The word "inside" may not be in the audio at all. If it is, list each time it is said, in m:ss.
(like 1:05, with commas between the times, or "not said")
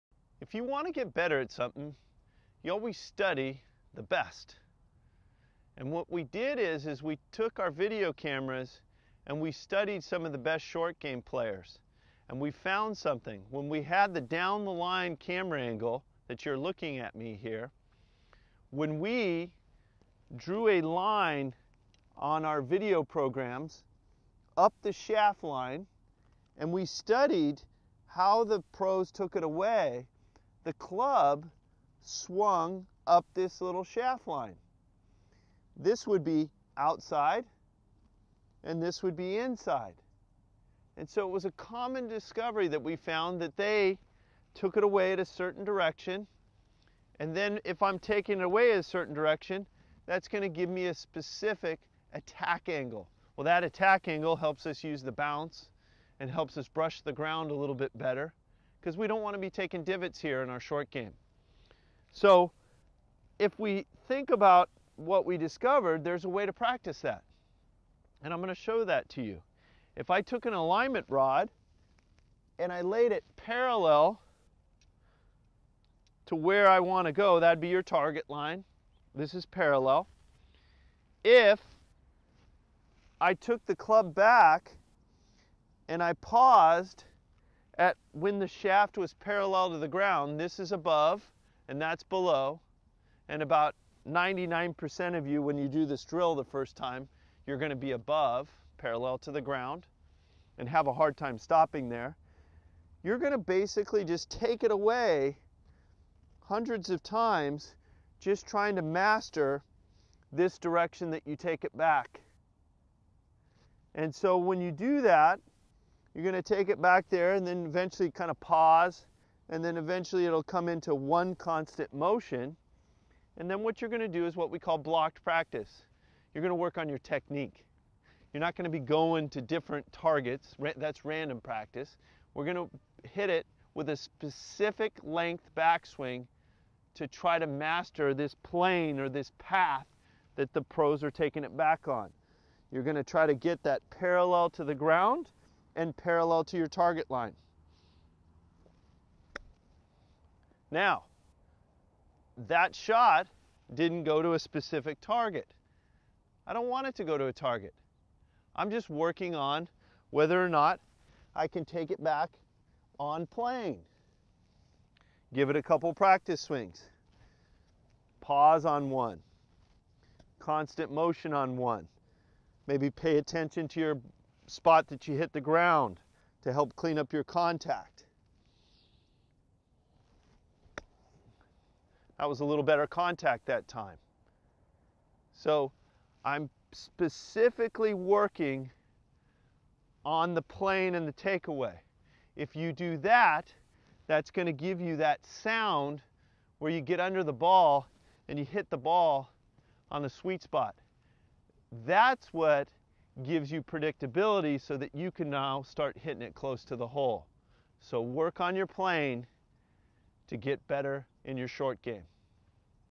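0:39.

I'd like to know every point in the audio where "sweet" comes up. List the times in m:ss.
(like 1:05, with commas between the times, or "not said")
3:20.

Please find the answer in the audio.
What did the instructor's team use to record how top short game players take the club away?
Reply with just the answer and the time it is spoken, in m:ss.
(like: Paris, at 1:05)
video cameras, at 0:07.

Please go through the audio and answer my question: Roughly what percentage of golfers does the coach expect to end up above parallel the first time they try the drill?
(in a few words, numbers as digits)
99%.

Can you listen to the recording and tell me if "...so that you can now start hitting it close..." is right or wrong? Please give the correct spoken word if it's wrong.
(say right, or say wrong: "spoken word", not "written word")
right.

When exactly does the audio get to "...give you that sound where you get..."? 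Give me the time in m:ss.
3:14.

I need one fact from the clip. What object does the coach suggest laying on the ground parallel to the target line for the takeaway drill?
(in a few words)
alignment rod.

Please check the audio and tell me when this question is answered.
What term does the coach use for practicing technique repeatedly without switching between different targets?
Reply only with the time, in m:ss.
2:04.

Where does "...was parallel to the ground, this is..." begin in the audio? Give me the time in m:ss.
1:28.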